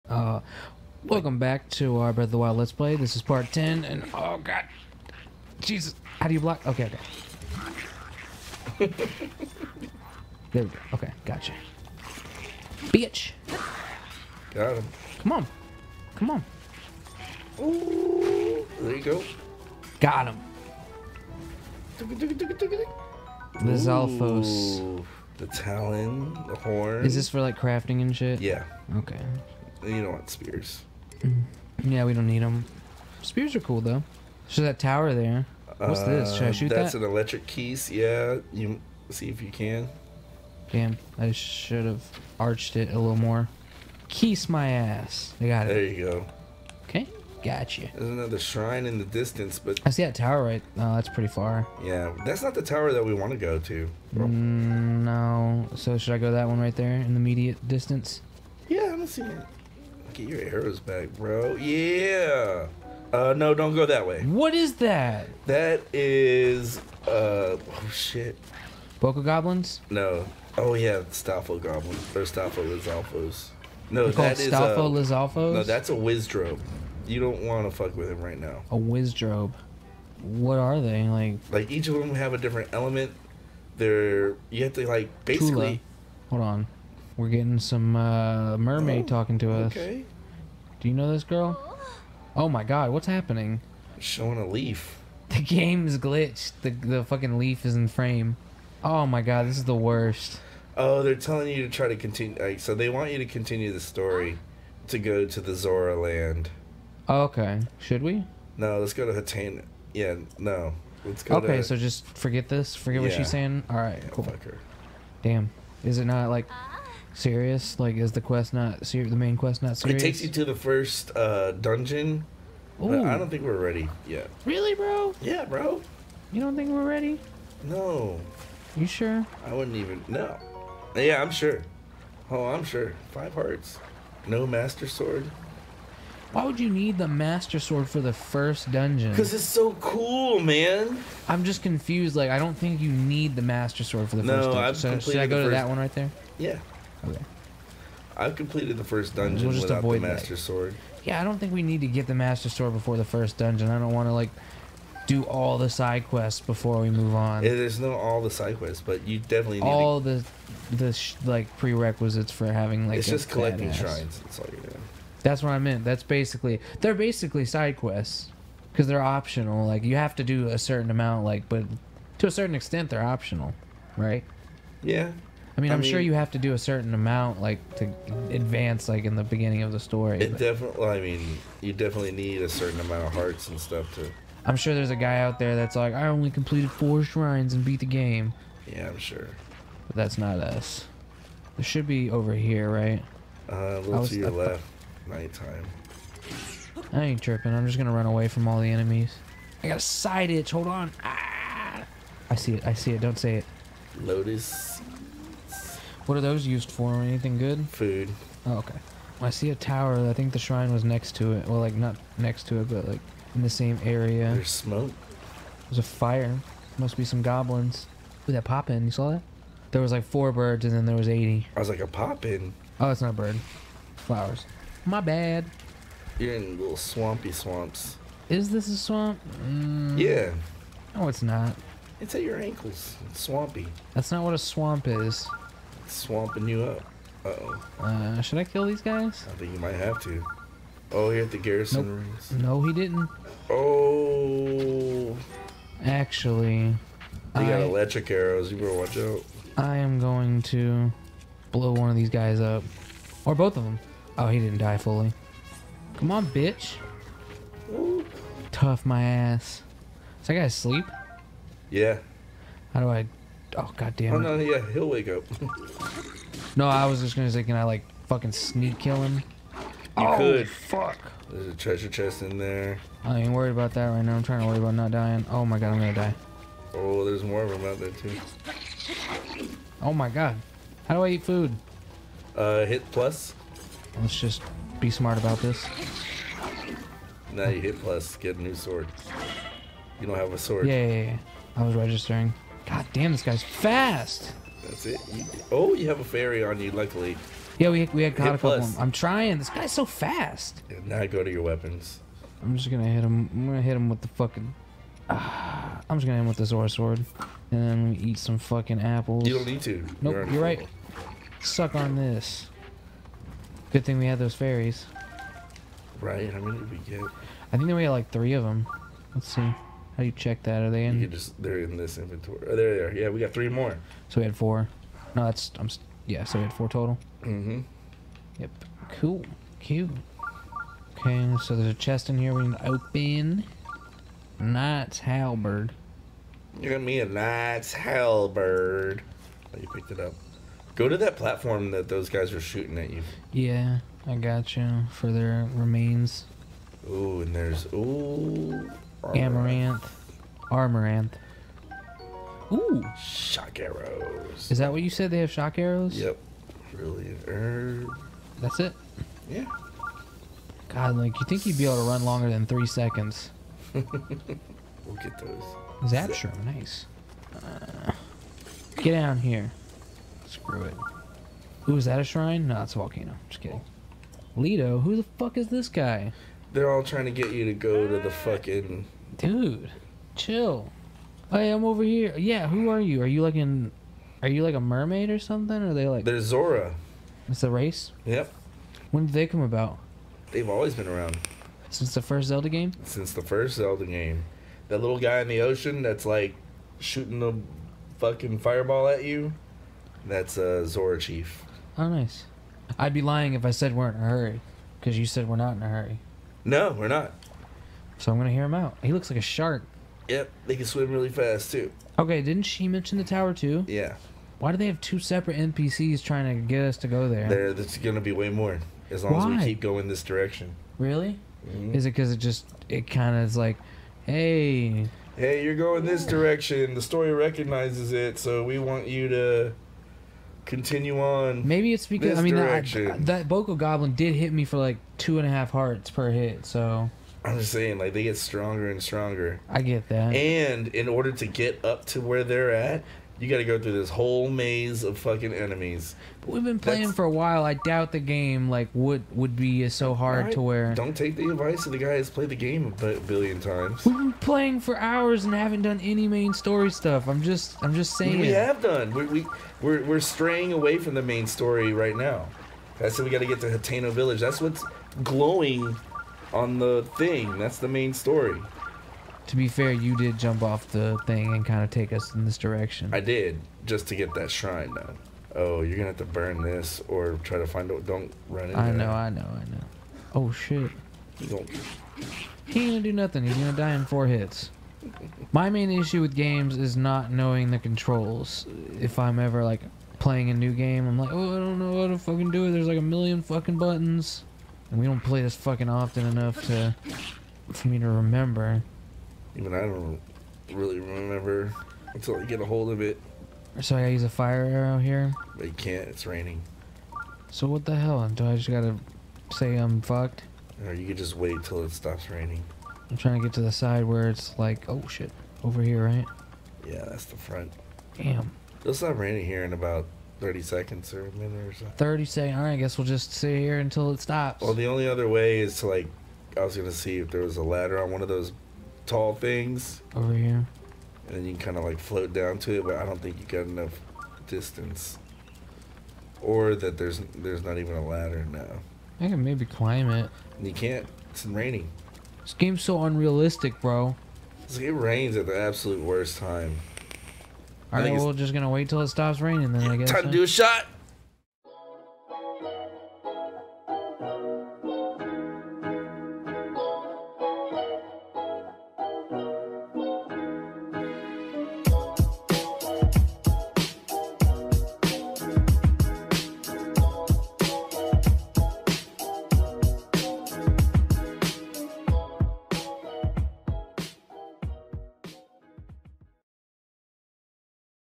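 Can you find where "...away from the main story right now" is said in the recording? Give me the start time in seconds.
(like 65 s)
460 s.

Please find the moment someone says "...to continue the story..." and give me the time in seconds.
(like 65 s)
103 s.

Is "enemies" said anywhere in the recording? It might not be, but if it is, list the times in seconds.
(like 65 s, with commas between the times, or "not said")
198 s, 445 s.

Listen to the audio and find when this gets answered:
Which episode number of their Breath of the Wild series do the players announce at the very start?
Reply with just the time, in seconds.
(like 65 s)
3 s.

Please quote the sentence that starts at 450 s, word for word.
Don't take the advice of the guy who's played the game a billion times.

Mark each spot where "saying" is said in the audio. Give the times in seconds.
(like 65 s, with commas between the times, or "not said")
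113 s, 437 s, 457 s.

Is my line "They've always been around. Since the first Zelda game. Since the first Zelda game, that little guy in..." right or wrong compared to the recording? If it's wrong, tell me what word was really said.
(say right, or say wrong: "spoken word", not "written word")
right.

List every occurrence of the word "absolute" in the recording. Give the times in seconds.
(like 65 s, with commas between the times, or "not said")
545 s.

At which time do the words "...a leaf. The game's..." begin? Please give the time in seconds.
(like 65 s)
94 s.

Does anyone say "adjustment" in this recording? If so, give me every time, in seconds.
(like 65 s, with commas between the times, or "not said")
not said.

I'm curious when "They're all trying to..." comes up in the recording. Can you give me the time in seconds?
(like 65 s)
376 s.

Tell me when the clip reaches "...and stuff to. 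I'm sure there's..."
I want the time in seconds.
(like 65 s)
183 s.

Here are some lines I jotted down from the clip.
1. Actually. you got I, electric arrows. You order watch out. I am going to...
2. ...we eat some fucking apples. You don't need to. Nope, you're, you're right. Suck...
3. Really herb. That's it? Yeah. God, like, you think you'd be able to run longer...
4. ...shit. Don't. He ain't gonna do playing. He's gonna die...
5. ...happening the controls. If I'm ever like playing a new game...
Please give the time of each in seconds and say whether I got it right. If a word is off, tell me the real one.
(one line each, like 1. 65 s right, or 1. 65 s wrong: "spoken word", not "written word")
1. 245 s wrong: "better", not "order"
2. 307 s right
3. 356 s right
4. 480 s wrong: "nothing", not "playing"
5. 487 s wrong: "knowing", not "happening".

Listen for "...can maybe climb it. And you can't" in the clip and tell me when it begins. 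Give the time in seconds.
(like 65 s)
539 s.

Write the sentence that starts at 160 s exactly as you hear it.
the the like prerequisites for having like.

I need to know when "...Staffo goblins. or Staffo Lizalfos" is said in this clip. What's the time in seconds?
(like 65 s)
71 s.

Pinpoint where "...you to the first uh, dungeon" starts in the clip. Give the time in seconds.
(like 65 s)
120 s.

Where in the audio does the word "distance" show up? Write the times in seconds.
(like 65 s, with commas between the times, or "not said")
49 s, 57 s, 534 s.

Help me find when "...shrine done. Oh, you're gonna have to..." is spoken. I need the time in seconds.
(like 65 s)
474 s.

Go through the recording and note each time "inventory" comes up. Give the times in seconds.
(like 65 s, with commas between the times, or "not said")
321 s.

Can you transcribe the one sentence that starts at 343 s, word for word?
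Yeah, I got you for their remains.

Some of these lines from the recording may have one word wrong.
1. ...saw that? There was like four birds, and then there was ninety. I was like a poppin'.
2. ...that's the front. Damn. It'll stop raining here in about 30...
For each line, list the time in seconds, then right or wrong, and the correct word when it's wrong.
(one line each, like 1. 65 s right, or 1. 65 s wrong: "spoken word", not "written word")
1. 218 s wrong: "eighty", not "ninety"
2. 516 s right.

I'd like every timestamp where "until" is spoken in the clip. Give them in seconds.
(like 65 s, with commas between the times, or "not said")
501 s, 523 s.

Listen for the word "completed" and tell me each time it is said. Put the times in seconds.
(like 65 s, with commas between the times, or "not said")
148 s, 186 s.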